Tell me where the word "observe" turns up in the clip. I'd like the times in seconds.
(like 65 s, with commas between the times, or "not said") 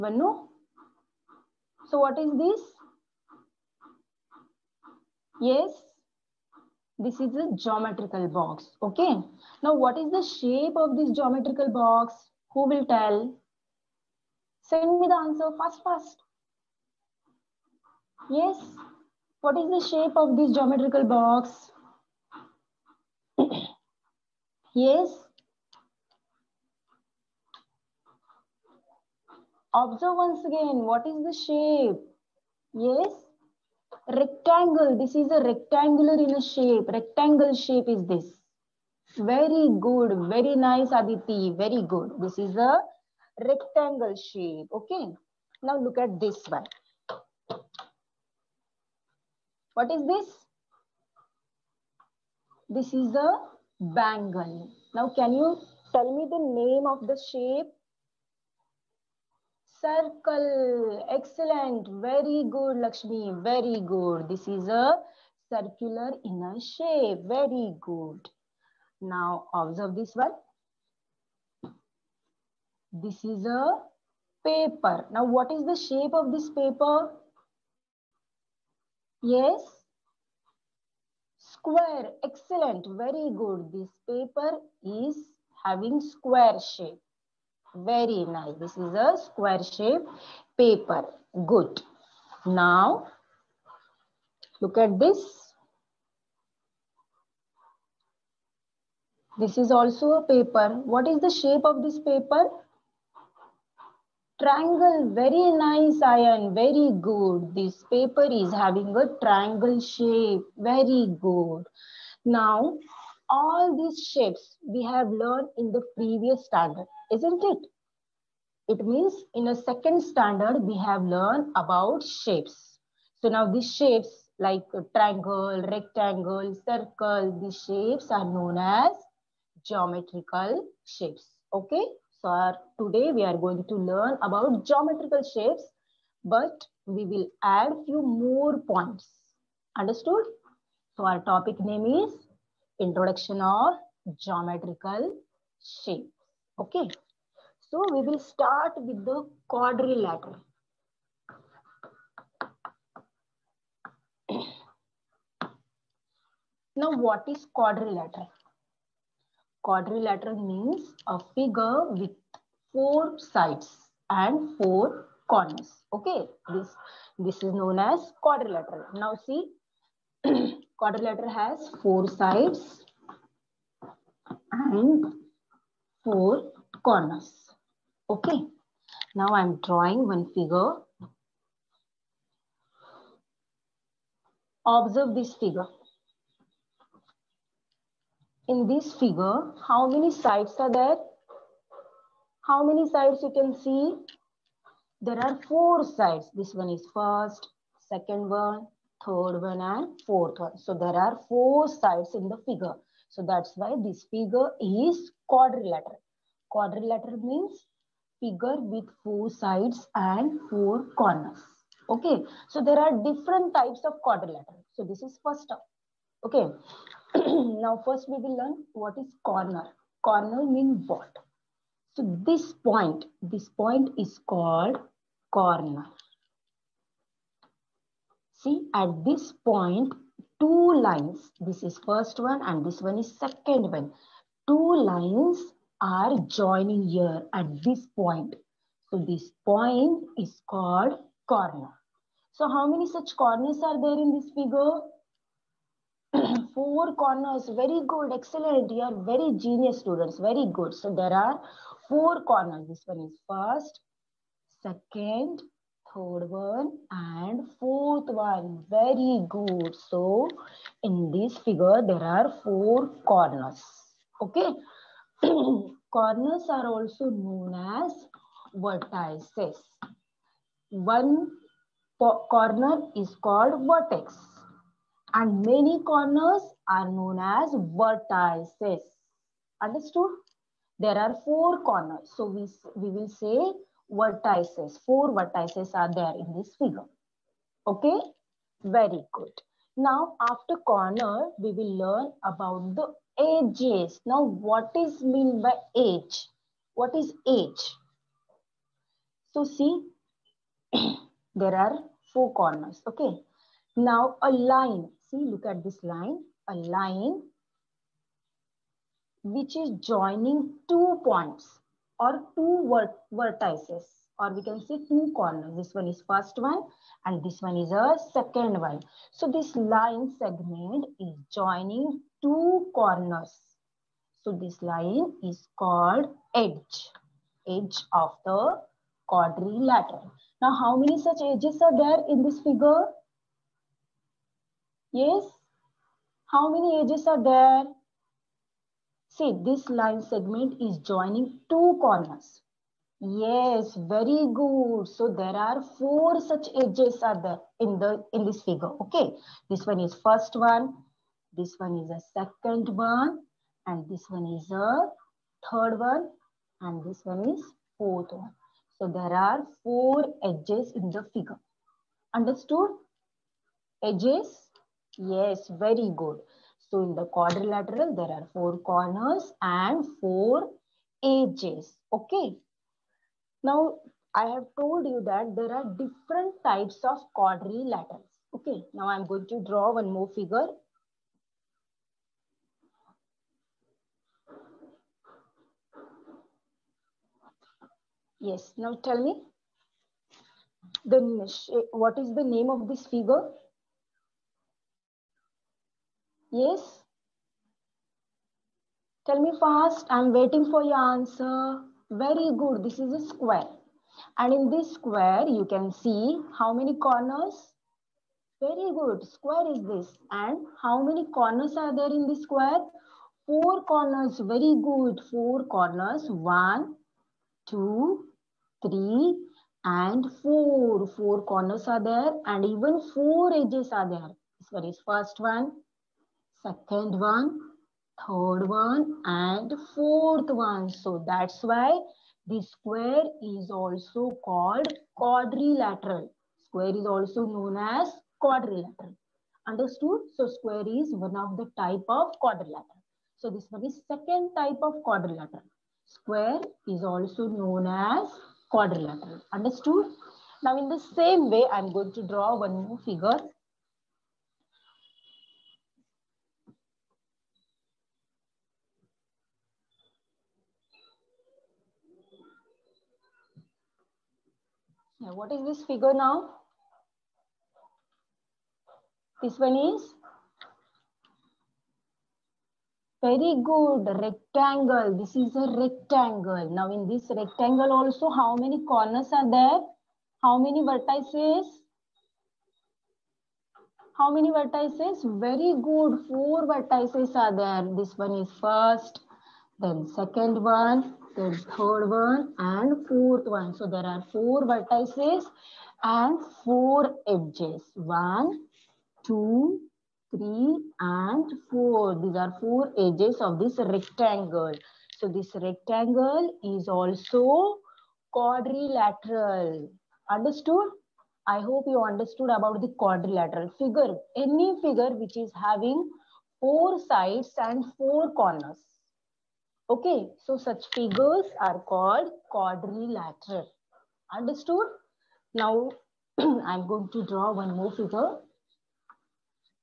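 29 s, 69 s, 184 s.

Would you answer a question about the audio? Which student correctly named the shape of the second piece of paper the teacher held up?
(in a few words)
Aryan.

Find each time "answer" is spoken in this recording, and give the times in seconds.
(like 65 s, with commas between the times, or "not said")
15 s, 400 s.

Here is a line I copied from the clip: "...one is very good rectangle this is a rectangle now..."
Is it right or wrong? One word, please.
right.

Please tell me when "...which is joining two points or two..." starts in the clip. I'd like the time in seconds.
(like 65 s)
309 s.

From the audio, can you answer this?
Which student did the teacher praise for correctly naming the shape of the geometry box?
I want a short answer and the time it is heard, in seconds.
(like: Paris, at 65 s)
Aditi, at 40 s.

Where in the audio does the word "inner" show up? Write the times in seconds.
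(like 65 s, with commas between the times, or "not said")
66 s.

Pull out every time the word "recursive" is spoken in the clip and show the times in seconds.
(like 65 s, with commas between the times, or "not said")
not said.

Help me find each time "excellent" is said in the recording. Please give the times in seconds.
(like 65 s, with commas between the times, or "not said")
61 s, 82 s, 248 s.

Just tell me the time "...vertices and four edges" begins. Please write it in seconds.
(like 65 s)
494 s.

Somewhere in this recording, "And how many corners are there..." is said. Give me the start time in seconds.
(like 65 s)
410 s.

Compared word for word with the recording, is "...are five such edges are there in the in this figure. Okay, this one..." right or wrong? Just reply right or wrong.
wrong.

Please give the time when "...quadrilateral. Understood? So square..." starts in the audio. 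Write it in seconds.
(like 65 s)
438 s.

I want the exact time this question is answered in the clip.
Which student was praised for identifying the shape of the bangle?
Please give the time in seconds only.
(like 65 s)
62 s.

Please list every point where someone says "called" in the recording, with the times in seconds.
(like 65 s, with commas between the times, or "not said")
224 s, 240 s, 273 s, 325 s, 434 s, 521 s.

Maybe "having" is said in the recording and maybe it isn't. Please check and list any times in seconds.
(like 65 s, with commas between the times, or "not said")
85 s, 108 s, 515 s.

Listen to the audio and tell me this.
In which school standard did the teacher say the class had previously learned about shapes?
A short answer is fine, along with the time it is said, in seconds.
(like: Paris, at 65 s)
second standard, at 119 s.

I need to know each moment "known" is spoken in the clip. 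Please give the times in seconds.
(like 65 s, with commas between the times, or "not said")
128 s, 167 s, 267 s, 276 s, 437 s, 447 s.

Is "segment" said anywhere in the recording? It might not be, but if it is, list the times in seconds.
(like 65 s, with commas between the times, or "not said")
320 s, 340 s.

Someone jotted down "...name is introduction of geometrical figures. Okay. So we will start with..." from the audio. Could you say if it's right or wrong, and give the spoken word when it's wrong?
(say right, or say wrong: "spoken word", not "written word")
wrong: "shapes", not "figures".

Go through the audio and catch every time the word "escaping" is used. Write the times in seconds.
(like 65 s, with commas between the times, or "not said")
not said.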